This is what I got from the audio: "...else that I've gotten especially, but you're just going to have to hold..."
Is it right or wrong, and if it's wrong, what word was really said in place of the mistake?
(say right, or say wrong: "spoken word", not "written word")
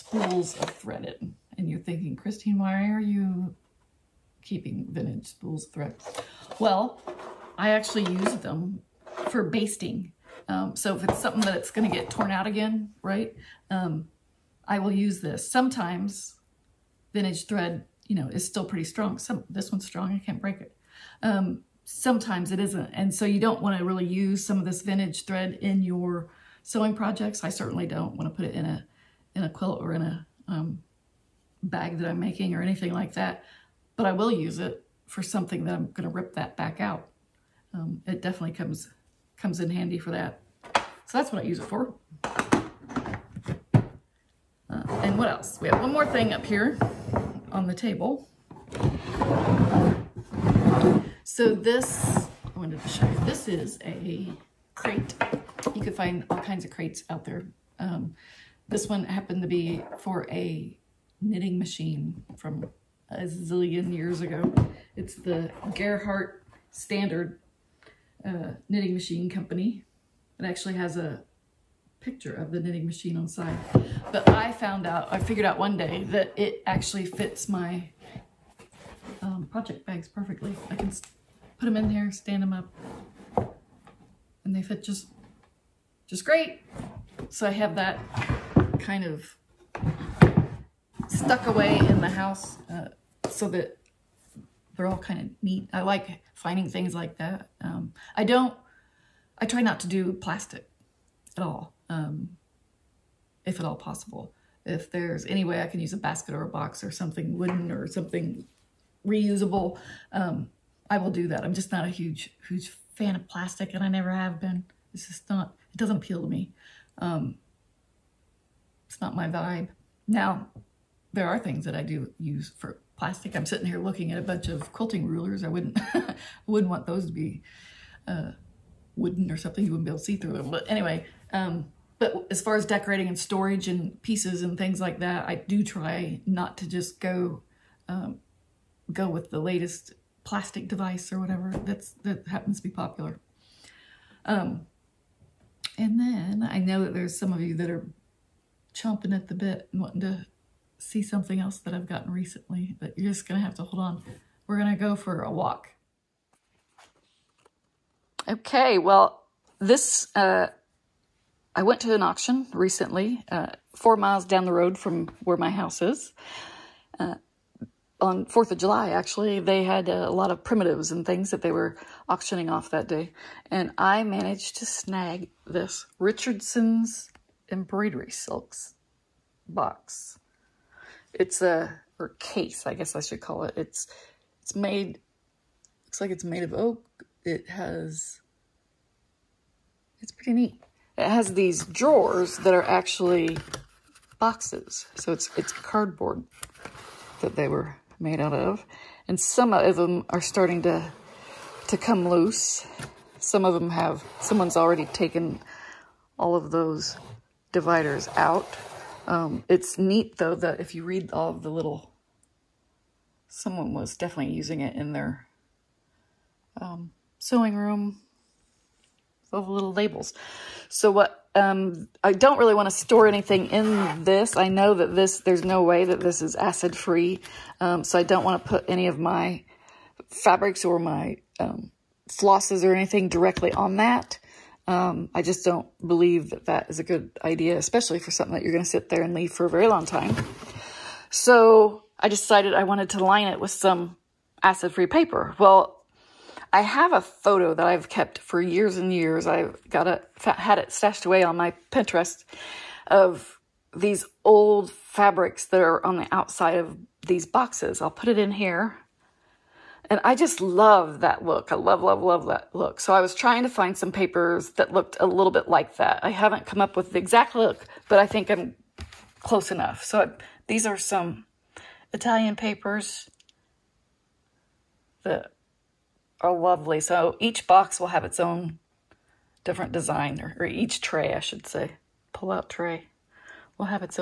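wrong: "recently", not "especially".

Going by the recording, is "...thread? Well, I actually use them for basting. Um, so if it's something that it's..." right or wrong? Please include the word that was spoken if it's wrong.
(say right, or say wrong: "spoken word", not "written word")
right.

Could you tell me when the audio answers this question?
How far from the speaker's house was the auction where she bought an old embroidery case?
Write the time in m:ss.
2:43.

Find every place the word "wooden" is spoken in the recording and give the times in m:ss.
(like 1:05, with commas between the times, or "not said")
1:47, 2:08.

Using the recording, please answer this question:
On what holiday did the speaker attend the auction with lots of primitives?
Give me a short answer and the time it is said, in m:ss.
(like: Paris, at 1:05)
4th of July, at 2:48.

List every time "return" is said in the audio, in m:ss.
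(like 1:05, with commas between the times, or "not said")
not said.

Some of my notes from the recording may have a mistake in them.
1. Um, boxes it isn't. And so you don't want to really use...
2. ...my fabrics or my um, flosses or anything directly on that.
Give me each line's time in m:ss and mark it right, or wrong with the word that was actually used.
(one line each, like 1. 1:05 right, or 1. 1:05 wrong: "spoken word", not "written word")
1. 0:21 wrong: "sometimes", not "boxes"
2. 3:48 right.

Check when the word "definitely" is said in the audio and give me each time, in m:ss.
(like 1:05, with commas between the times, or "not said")
0:38, 3:33.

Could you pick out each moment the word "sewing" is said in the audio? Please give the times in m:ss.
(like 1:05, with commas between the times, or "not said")
0:26, 3:37.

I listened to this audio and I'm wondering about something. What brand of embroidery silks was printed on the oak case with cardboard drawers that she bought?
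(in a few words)
Richardson's.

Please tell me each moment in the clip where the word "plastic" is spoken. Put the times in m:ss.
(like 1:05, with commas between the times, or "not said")
1:40, 1:53, 2:02, 2:20.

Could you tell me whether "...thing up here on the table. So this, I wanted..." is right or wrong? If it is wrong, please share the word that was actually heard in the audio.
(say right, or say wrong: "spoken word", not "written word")
right.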